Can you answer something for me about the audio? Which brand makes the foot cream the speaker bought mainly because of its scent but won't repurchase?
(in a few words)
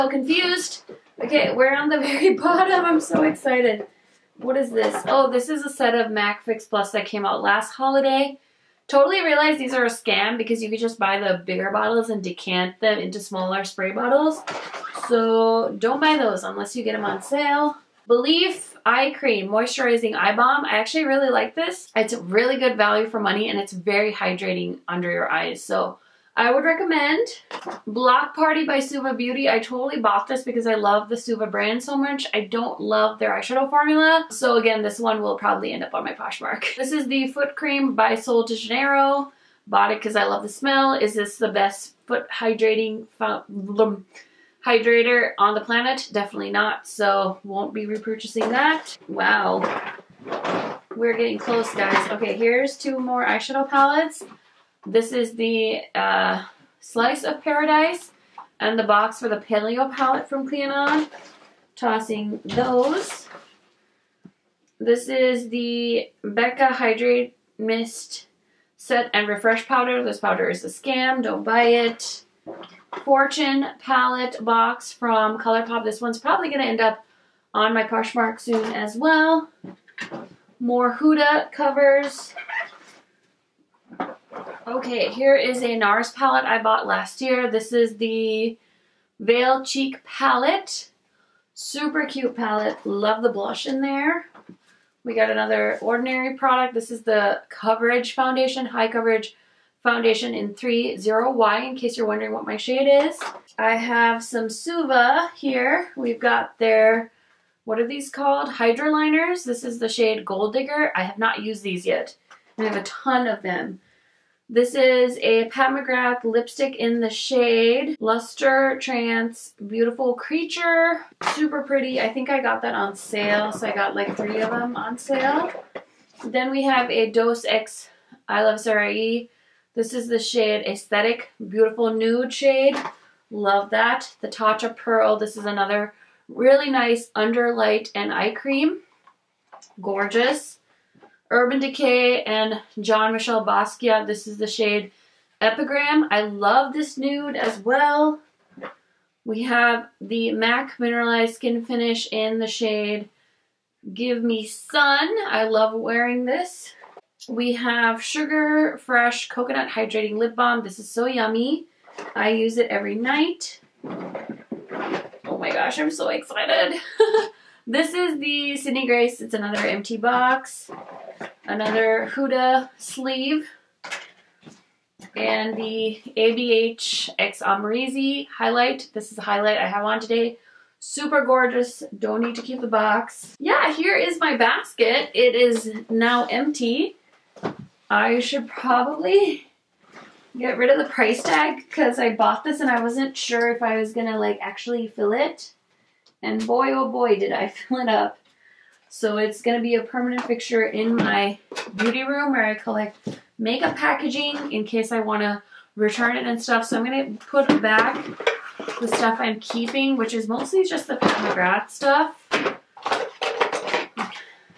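Sol de Janeiro.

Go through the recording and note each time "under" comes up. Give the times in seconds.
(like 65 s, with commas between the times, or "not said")
24 s, 137 s.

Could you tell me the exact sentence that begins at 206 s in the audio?
So I'm going to put back the stuff I'm keeping, which is mostly just the Pat McGrath stuff.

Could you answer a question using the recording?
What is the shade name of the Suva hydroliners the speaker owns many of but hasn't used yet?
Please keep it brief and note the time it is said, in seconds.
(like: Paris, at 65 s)
Gold Digger, at 110 s.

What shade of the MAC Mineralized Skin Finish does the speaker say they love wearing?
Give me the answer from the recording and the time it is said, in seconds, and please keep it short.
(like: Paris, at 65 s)
Give Me Sun, at 153 s.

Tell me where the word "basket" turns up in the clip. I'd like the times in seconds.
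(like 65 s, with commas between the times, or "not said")
184 s.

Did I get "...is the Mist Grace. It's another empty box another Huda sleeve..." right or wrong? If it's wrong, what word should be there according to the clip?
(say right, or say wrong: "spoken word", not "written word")
wrong: "Sydney", not "Mist".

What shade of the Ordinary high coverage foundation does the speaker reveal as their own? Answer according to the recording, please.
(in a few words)
30Y.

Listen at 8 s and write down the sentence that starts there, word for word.
Totally realize these are a scam because you could just buy the bigger bottles and decant them into smaller spray bottles.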